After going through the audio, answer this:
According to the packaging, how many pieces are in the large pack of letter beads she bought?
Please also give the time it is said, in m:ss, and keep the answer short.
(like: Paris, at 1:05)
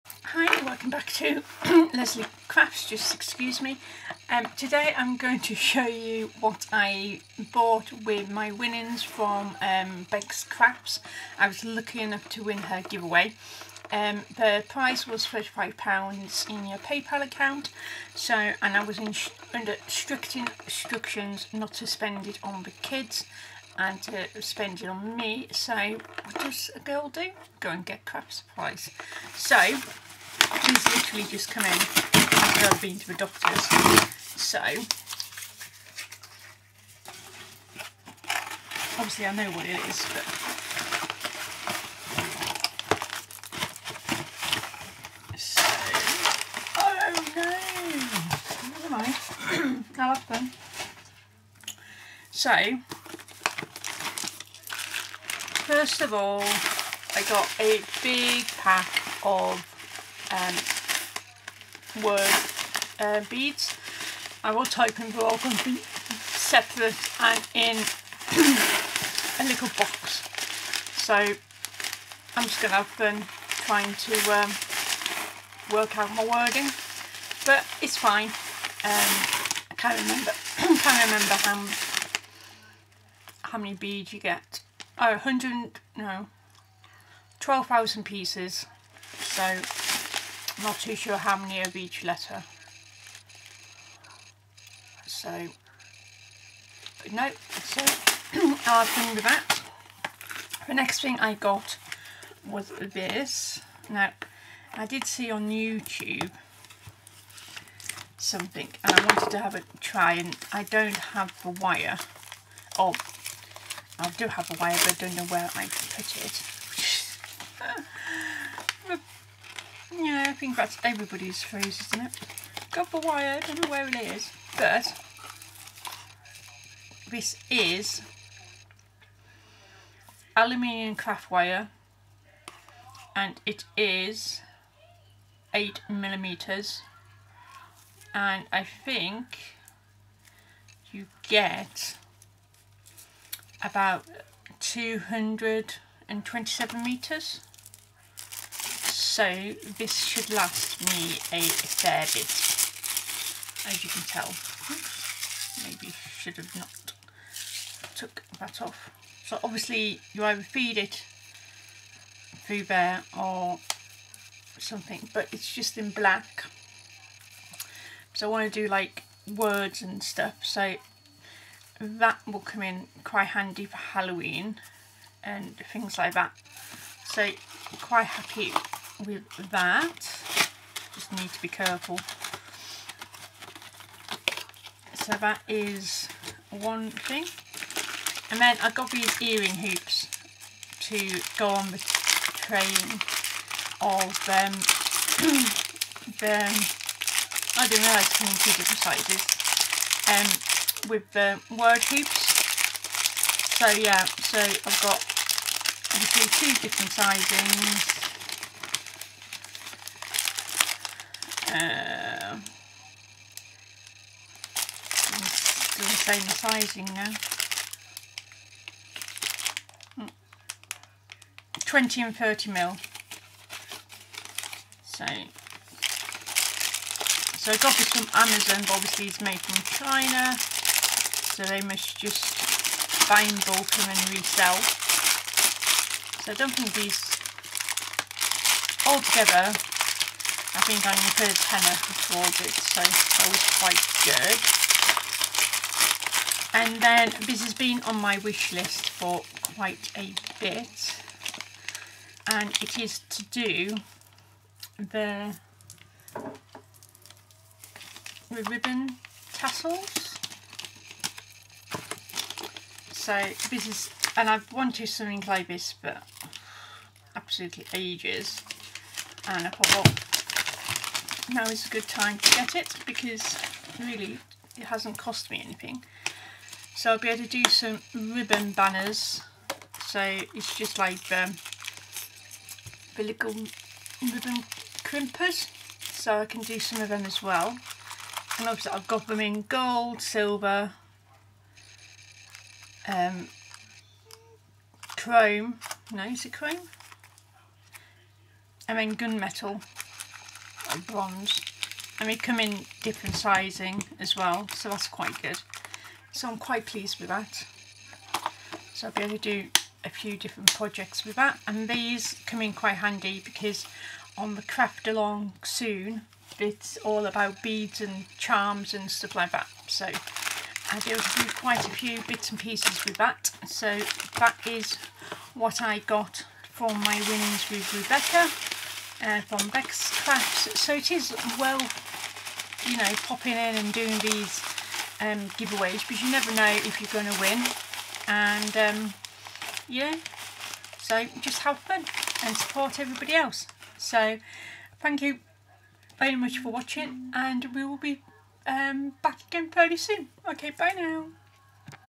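12,000, at 1:27.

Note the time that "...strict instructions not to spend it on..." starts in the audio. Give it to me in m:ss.
0:19.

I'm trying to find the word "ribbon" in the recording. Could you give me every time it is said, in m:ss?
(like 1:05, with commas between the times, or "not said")
4:18, 4:37, 4:44.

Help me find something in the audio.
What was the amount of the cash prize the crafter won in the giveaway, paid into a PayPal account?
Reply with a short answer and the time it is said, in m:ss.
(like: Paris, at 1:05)
£35, at 0:15.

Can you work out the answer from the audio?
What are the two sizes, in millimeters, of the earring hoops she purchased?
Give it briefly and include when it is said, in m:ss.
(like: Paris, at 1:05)
20 and 30 mil, at 3:41.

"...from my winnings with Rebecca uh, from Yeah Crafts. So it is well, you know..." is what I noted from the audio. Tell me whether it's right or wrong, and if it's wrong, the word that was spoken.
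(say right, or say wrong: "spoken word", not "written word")
wrong: "Bex", not "Yeah".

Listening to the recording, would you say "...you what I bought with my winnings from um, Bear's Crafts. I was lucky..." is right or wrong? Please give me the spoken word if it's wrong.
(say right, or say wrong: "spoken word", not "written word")
wrong: "Beck", not "Bear".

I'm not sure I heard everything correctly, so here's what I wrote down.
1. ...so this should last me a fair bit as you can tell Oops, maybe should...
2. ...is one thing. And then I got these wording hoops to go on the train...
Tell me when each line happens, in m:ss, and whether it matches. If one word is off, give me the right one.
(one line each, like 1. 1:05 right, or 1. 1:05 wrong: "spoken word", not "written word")
1. 2:29 right
2. 3:05 wrong: "earring", not "wording".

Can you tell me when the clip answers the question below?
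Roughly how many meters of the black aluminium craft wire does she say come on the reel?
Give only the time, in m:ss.
2:24.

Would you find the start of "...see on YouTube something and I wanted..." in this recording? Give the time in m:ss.
1:45.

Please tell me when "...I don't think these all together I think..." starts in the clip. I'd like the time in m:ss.
3:56.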